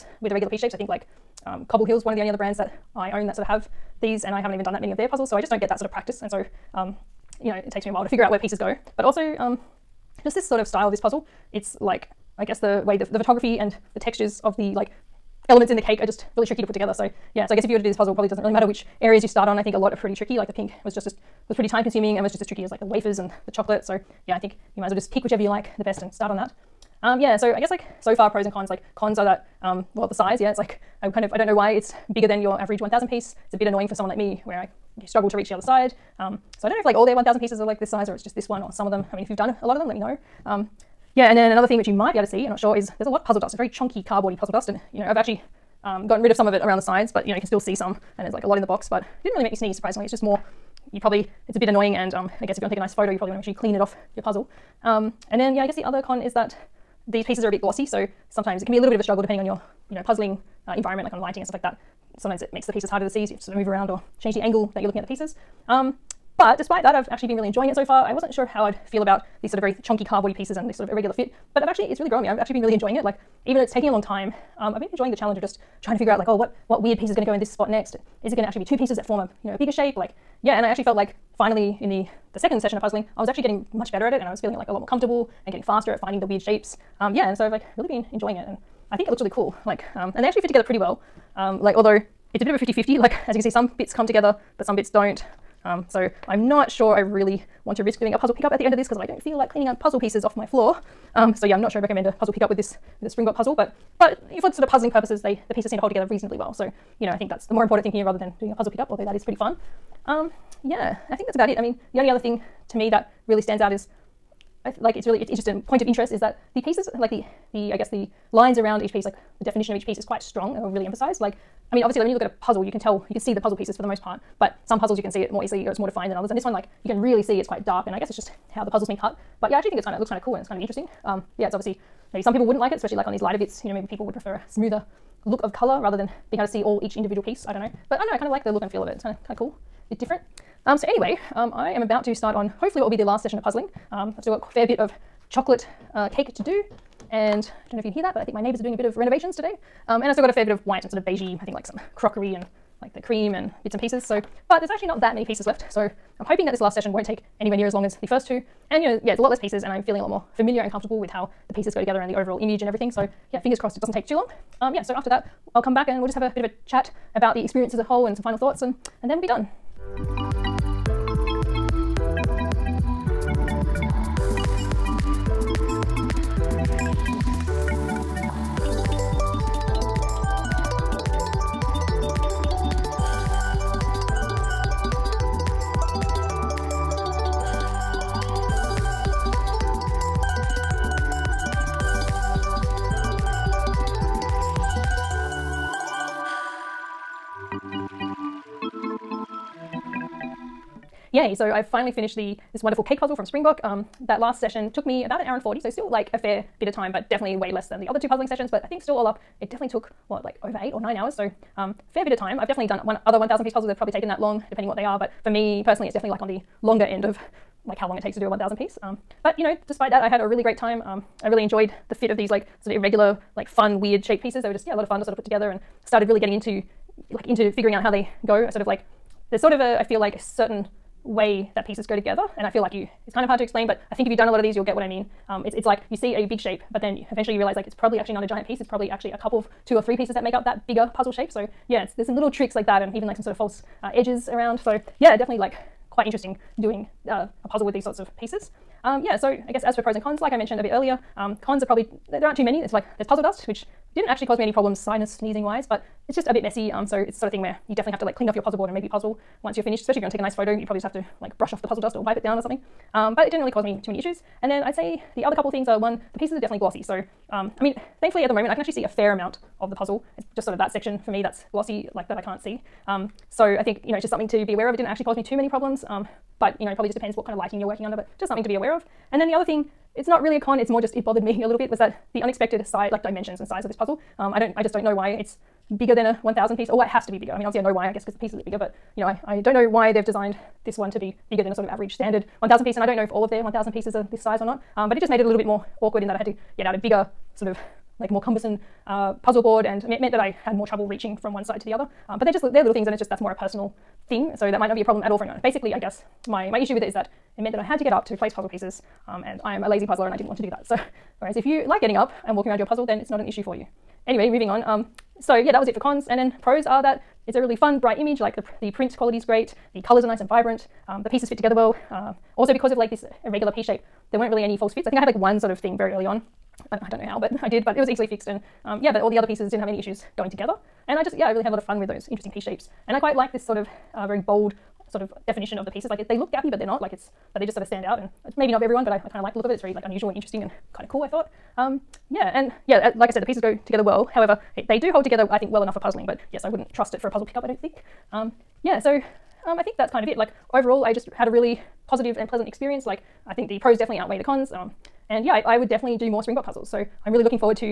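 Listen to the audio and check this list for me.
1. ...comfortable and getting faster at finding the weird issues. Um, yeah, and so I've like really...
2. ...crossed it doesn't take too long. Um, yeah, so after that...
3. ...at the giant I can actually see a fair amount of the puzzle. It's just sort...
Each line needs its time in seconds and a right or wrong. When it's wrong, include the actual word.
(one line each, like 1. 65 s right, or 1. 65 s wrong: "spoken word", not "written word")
1. 84 s wrong: "shapes", not "issues"
2. 163 s right
3. 268 s wrong: "moment", not "giant".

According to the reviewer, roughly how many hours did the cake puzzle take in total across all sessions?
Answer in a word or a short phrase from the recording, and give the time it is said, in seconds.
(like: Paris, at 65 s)
eight or nine hours, at 210 s.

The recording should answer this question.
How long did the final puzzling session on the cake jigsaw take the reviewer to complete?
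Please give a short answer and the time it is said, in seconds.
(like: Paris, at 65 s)
about an hour and 40, at 205 s.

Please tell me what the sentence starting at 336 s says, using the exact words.
Like it's, but they just sort of stand out.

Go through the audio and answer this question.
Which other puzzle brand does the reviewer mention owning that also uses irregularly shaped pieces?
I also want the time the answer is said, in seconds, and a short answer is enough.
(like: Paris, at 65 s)
Cobble Hill, at 1 s.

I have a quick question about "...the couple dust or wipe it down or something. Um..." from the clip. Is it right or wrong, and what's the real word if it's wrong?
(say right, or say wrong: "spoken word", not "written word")
wrong: "puzzle", not "couple".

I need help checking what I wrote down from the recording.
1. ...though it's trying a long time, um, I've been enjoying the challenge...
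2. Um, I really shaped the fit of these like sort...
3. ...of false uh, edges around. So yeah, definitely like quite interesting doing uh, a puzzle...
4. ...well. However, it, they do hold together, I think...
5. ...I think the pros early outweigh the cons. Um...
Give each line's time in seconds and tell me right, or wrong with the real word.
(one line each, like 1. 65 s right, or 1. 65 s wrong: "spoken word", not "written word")
1. 73 s wrong: "taking", not "trying"
2. 220 s wrong: "enjoyed", not "shaped"
3. 243 s right
4. 343 s right
5. 353 s wrong: "definitely", not "early".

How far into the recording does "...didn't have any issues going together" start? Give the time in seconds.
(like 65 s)
329 s.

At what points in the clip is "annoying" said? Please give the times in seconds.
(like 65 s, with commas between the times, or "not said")
33 s, 51 s.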